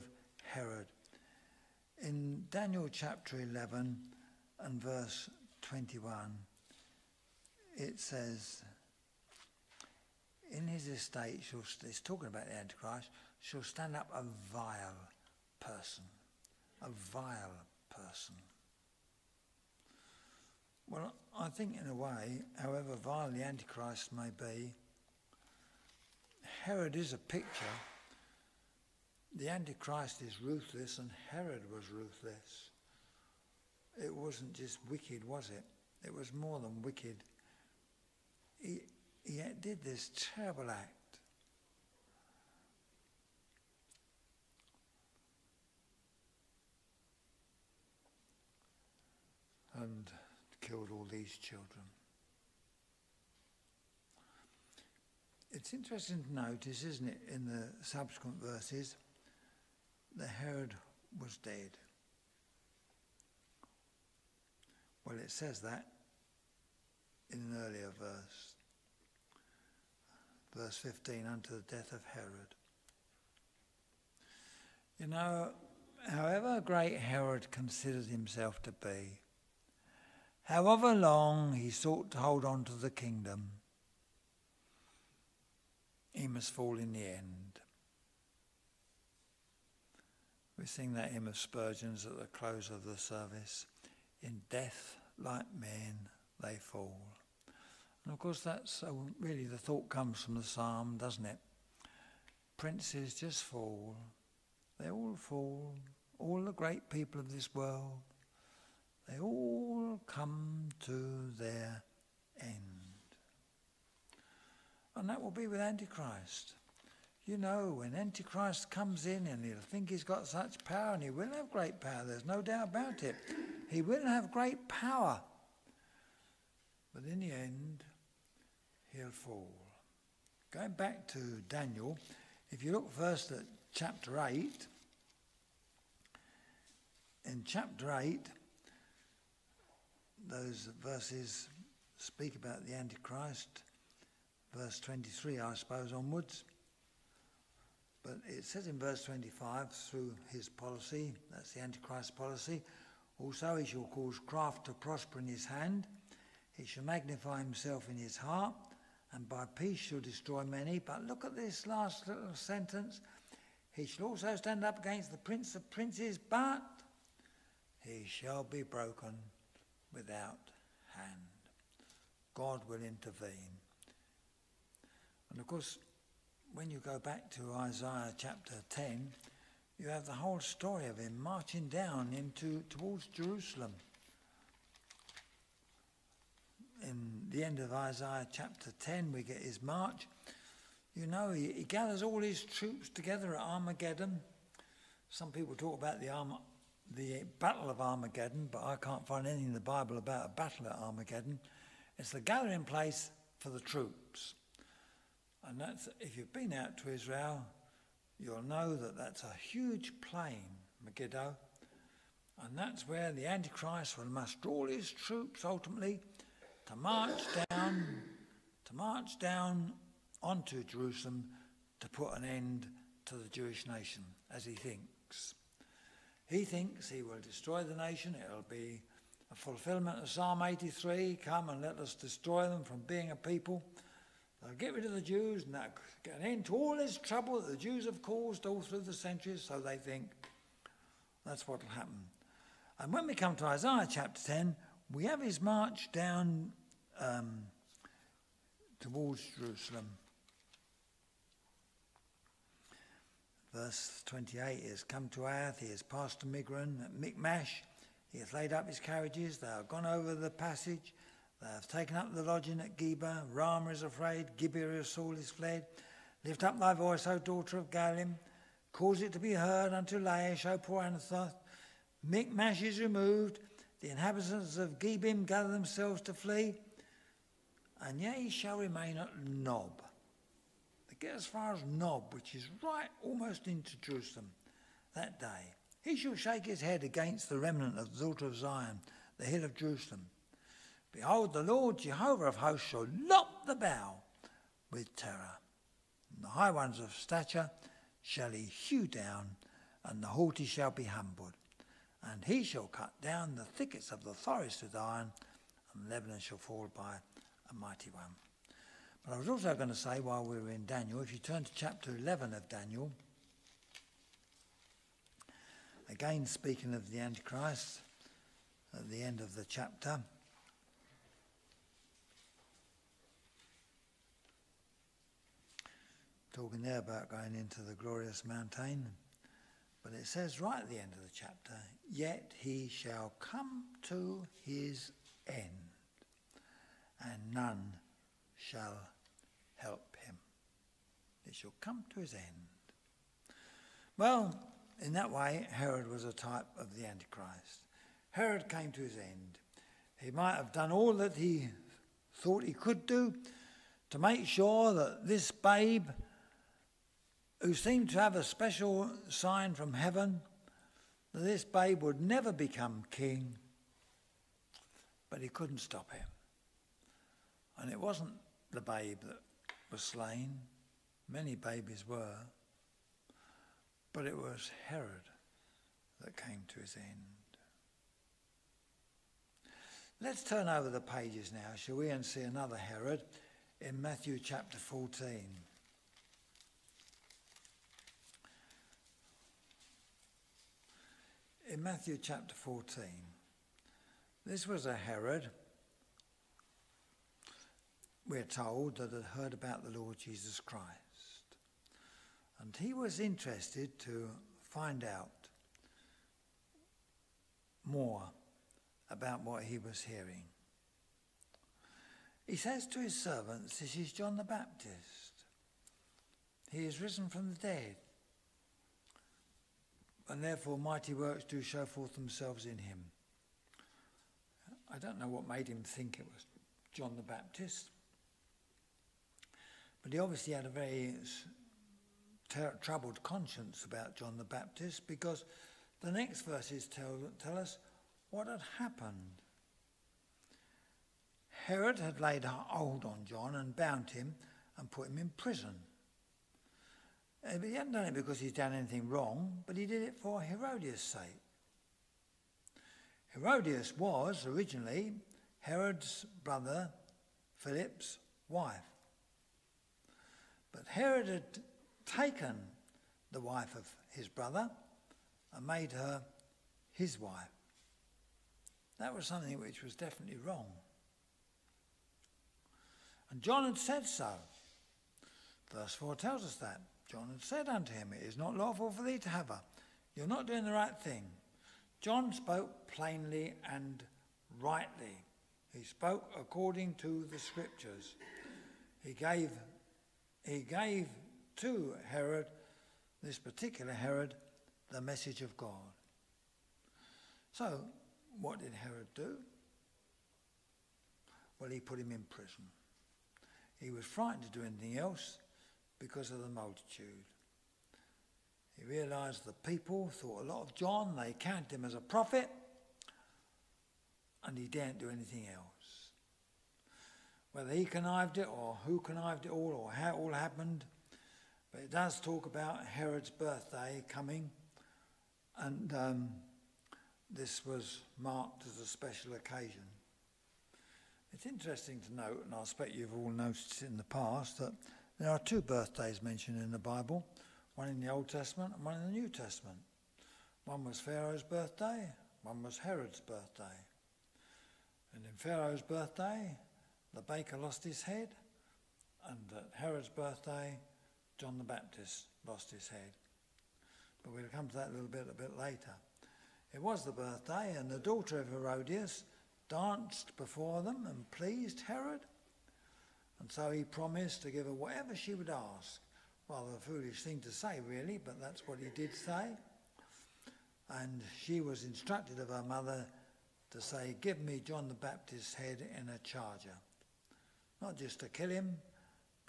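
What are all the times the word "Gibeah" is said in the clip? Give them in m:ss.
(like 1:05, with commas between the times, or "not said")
4:24, 4:34.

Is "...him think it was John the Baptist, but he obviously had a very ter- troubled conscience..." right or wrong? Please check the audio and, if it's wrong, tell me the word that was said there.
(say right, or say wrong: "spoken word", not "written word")
right.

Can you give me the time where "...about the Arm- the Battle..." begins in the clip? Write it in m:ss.
3:15.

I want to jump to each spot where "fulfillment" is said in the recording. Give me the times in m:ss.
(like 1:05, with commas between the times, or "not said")
3:49.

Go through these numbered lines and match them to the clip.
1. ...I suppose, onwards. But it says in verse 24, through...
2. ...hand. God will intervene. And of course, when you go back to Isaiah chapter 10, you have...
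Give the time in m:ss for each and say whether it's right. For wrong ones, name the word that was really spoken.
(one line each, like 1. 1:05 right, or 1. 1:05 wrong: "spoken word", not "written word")
1. 2:25 wrong: "25", not "24"
2. 2:50 right.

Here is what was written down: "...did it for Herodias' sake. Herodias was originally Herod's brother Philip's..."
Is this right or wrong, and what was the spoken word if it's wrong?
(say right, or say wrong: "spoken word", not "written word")
right.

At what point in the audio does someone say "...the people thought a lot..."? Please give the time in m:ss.
8:29.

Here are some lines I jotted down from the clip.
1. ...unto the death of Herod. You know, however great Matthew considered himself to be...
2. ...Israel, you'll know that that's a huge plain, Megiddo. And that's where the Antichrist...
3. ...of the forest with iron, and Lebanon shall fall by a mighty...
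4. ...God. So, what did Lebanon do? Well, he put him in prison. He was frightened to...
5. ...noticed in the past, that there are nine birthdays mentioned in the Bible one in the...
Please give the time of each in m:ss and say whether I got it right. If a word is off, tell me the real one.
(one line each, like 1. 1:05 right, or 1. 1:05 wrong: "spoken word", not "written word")
1. 1:11 wrong: "Herod", not "Matthew"
2. 3:26 right
3. 5:03 right
4. 8:15 wrong: "Herod", not "Lebanon"
5. 8:53 wrong: "two", not "nine".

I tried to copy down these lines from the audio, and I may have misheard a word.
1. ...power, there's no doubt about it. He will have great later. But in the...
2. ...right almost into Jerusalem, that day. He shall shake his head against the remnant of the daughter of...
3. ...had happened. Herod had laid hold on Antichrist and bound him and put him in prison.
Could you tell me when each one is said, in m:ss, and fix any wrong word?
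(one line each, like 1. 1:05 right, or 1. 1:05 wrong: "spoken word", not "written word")
1. 2:01 wrong: "power", not "later"
2. 4:42 right
3. 7:18 wrong: "John", not "Antichrist".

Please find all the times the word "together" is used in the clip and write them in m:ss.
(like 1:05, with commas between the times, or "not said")
3:12.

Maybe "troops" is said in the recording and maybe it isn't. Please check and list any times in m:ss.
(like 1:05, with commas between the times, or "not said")
3:12, 3:23, 3:34.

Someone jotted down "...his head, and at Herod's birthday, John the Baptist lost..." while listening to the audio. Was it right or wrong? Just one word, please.
right.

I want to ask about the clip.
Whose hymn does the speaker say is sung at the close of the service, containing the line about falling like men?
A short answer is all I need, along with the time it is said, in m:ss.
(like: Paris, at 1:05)
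Spurgeon, at 1:31.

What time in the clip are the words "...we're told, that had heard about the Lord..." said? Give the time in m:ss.
6:38.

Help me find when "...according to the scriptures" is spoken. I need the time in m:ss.
8:06.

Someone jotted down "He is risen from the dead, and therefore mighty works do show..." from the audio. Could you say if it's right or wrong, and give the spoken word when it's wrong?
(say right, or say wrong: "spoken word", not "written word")
right.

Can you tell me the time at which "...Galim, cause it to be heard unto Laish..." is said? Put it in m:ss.
4:27.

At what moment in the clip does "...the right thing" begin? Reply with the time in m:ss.
8:00.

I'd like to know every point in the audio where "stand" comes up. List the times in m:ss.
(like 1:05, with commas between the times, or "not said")
0:13, 2:44.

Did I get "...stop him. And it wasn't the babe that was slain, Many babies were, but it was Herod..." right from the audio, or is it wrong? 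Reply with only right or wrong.
right.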